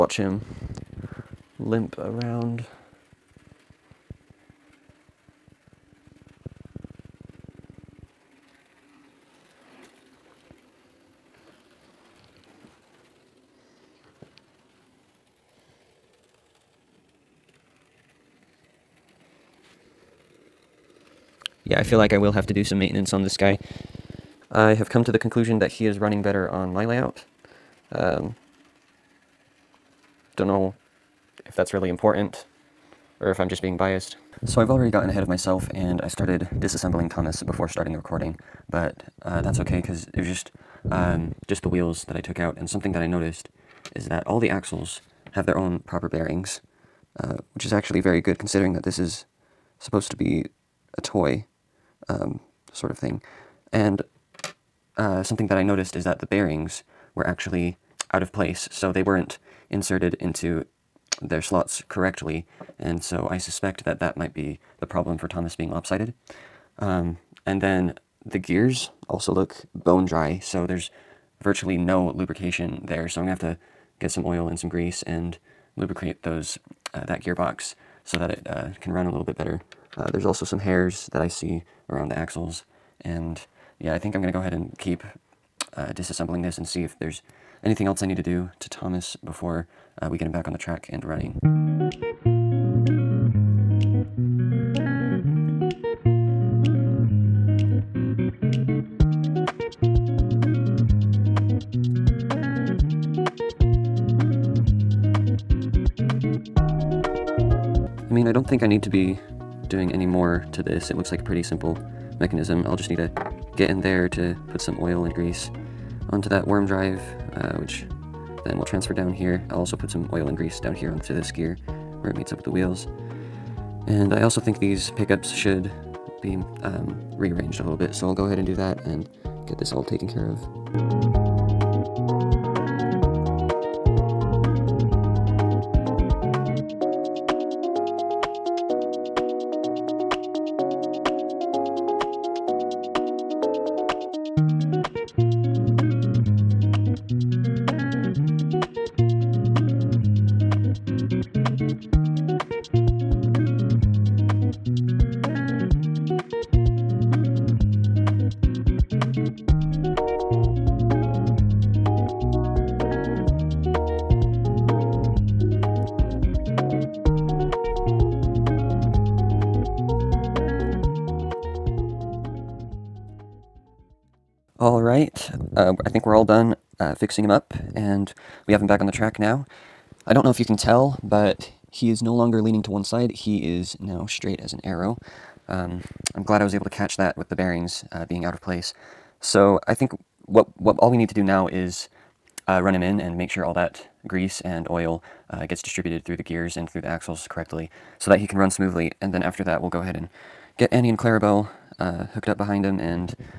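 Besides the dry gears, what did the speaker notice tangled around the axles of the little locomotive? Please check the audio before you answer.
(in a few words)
Hairs.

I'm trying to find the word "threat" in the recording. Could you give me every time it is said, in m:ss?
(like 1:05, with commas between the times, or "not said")
not said.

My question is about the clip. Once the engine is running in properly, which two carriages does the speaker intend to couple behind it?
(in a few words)
Annie and Clarabel.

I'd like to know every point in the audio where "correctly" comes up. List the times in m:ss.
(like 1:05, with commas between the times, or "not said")
1:01, 3:17.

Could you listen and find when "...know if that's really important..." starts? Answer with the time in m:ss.
0:30.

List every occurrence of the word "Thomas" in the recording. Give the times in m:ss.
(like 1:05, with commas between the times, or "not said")
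0:37, 1:05, 1:28.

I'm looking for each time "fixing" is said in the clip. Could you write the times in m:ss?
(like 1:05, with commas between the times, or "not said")
2:56.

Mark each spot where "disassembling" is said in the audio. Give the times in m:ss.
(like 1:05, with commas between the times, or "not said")
0:36, 1:25.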